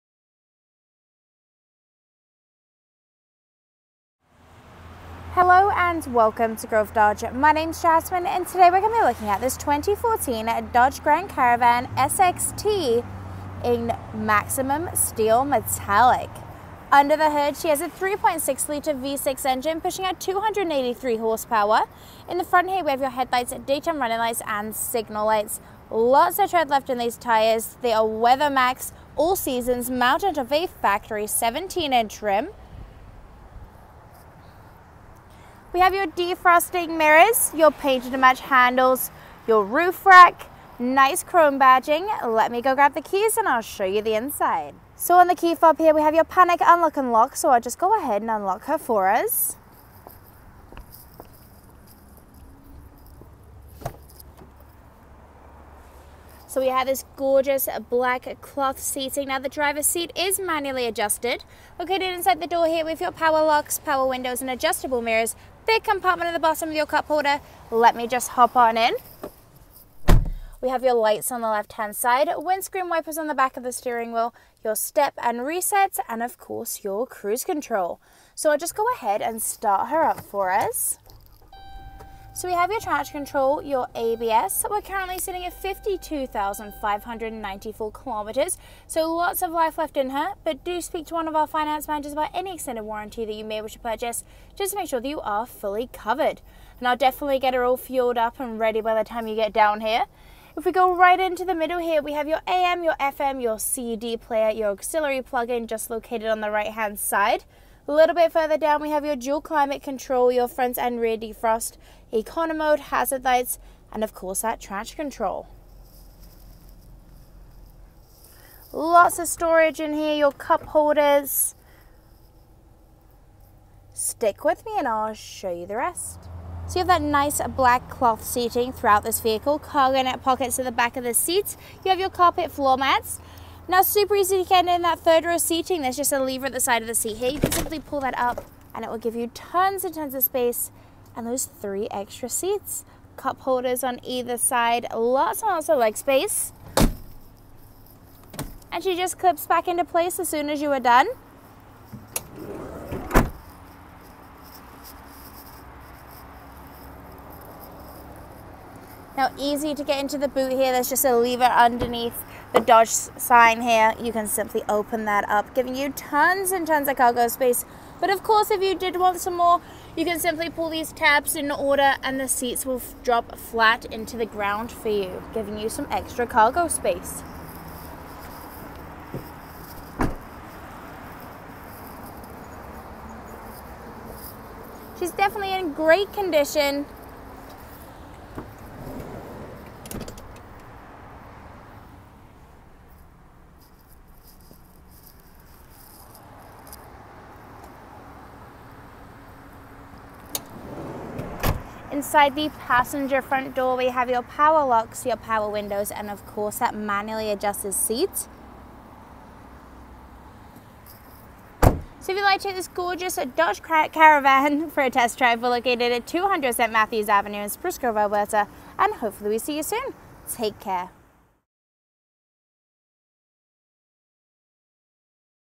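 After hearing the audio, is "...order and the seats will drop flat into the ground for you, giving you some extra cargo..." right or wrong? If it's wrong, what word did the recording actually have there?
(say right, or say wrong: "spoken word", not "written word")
right.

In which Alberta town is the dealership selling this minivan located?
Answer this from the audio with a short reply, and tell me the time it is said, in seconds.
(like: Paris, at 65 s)
Spruce Grove, at 217 s.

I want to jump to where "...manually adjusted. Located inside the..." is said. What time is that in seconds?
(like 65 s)
60 s.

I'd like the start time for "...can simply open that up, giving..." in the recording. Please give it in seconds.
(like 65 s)
164 s.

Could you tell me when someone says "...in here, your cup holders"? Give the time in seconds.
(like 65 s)
119 s.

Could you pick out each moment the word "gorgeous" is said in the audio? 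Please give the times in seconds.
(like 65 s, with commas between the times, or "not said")
57 s, 212 s.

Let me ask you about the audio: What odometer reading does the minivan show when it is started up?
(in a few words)
52,594 kilometres.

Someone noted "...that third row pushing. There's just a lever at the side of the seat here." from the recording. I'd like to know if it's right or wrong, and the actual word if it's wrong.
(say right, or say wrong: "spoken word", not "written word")
wrong: "seating", not "pushing".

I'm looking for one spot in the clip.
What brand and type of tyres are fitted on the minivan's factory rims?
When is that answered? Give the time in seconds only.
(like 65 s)
28 s.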